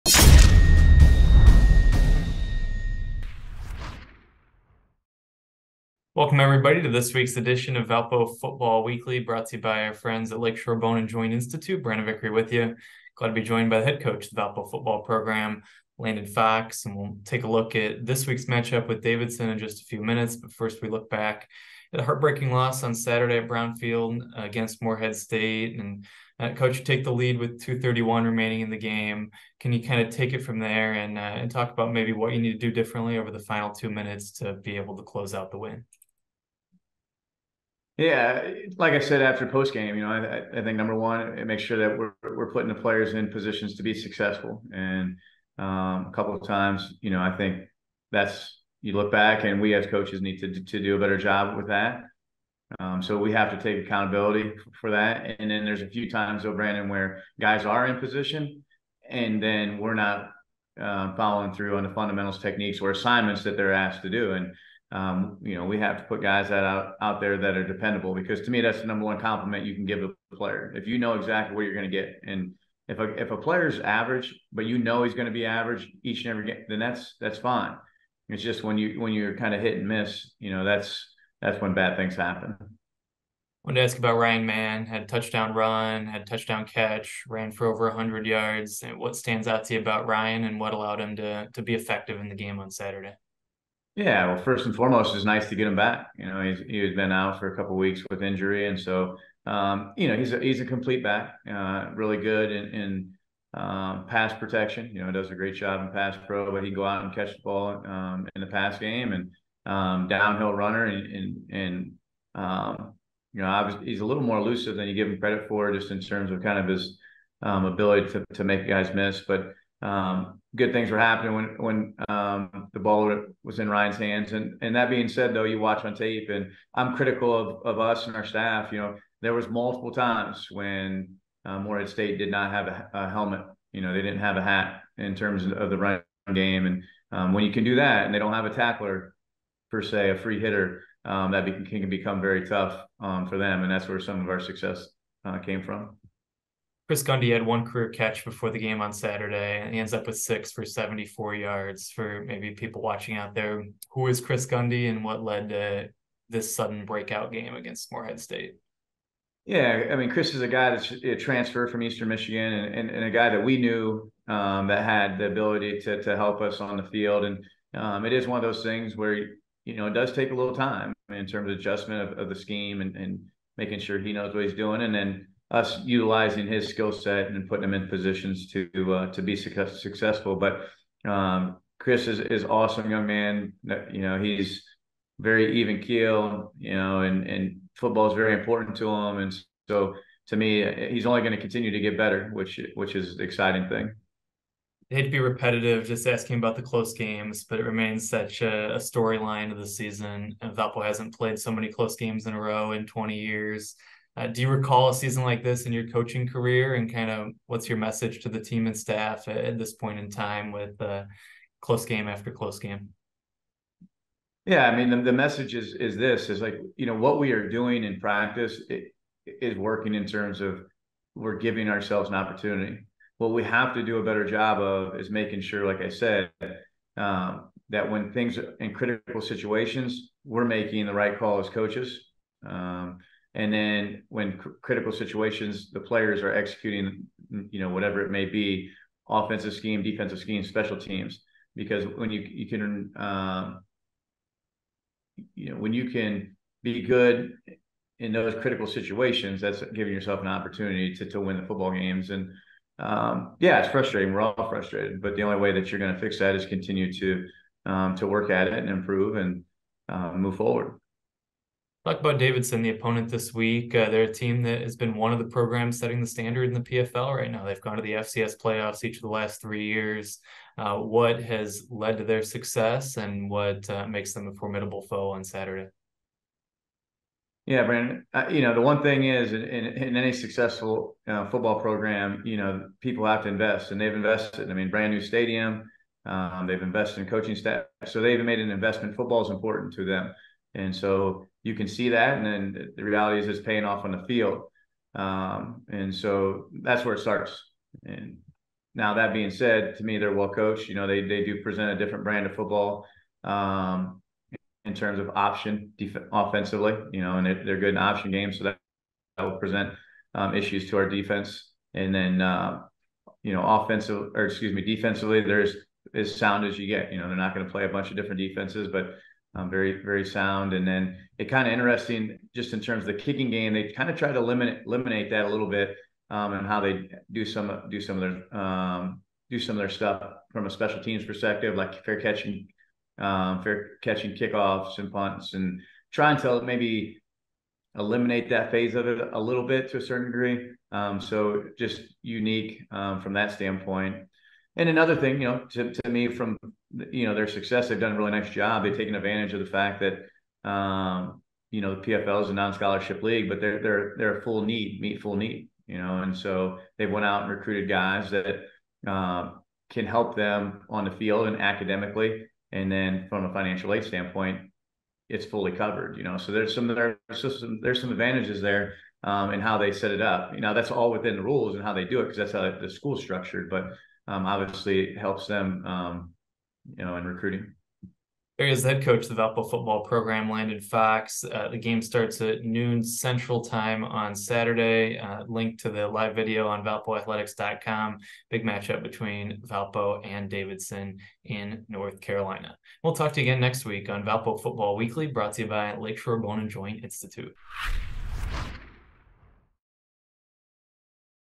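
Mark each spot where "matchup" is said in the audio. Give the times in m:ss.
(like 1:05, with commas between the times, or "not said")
0:18, 6:28.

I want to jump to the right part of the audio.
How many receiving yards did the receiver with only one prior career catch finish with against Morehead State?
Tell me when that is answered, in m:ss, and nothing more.
2:30.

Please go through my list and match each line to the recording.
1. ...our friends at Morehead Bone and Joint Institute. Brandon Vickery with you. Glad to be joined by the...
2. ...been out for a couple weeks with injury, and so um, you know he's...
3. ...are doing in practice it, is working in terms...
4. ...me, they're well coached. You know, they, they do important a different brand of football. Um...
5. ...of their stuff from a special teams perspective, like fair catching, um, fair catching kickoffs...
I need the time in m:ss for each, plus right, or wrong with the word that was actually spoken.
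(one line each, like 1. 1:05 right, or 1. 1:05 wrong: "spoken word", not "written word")
1. 0:09 wrong: "Lakeshore", not "Morehead"
2. 1:36 right
3. 3:37 right
4. 4:59 wrong: "present", not "important"
5. 5:29 right.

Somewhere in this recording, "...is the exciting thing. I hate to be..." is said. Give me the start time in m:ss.
3:12.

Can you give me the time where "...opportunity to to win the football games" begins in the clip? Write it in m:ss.
4:10.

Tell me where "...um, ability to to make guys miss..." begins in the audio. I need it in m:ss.
1:57.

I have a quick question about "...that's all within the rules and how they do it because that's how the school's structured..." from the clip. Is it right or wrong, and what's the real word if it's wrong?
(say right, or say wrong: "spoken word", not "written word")
right.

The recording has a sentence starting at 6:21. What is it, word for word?
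Uh, the game starts at noon Central Time on Saturday.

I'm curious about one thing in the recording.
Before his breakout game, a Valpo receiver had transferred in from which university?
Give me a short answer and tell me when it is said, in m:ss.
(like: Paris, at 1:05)
Eastern Michigan, at 2:41.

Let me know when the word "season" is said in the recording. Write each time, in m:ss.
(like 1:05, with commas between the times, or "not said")
3:19, 3:24.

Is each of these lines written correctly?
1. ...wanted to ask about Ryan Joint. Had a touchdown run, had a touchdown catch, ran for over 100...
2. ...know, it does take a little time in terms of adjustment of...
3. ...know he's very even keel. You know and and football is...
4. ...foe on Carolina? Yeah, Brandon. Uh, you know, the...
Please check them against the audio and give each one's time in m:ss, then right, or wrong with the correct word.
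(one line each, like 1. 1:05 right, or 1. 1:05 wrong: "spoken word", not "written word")
1. 1:23 wrong: "Mann", not "Joint"
2. 2:49 right
3. 3:04 right
4. 4:34 wrong: "Saturday", not "Carolina".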